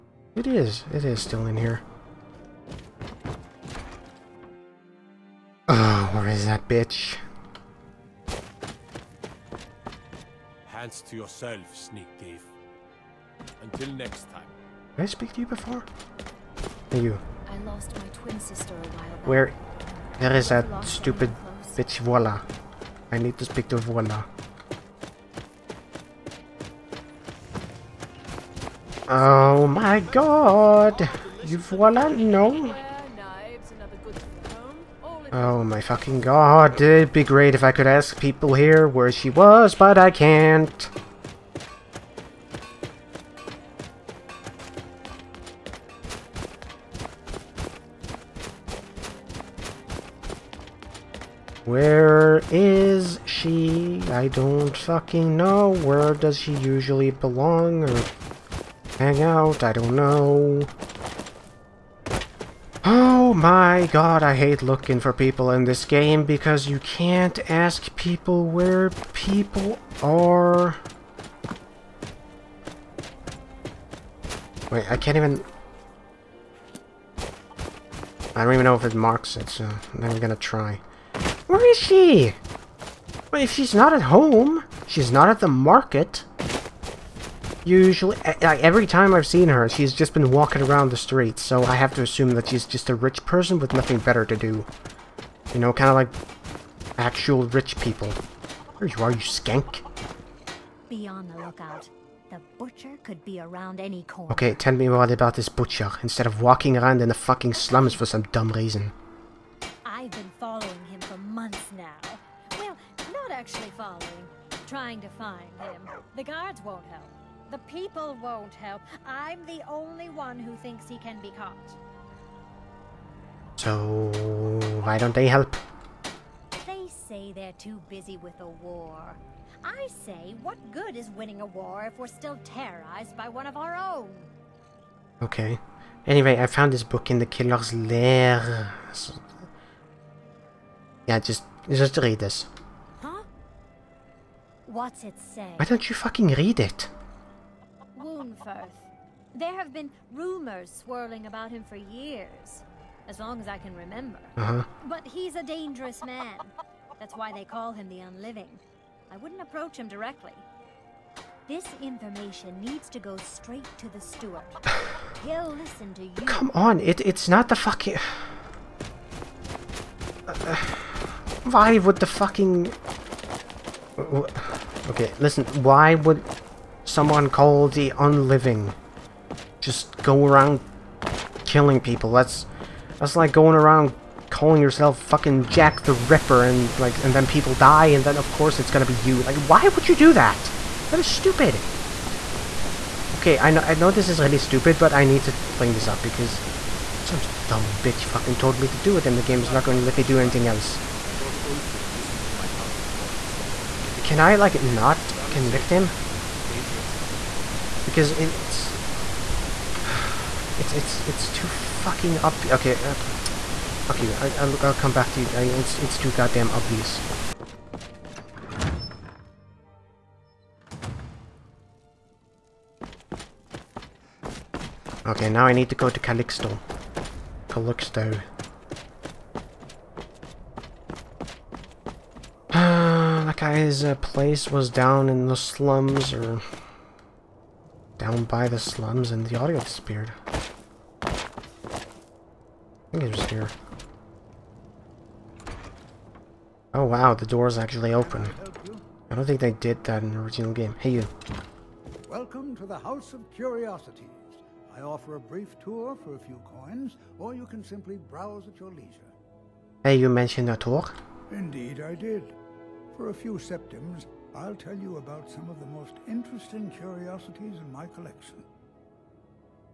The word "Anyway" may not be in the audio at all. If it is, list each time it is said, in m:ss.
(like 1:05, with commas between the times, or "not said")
2:16.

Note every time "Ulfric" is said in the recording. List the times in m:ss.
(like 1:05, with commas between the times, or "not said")
3:21.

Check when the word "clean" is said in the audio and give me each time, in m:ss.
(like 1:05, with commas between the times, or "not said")
3:15.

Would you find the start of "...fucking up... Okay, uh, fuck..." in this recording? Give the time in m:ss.
3:31.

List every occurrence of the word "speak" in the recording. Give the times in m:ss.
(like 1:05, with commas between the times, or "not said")
0:15, 0:23.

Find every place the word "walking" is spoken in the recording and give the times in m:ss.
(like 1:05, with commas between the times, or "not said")
1:30, 1:46.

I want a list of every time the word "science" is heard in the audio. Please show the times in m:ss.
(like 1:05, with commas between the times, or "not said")
not said.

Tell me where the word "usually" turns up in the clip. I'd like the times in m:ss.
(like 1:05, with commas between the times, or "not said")
0:56, 1:27.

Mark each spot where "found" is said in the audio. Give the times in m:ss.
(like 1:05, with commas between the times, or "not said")
2:16.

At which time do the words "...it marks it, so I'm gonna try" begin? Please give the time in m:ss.
1:18.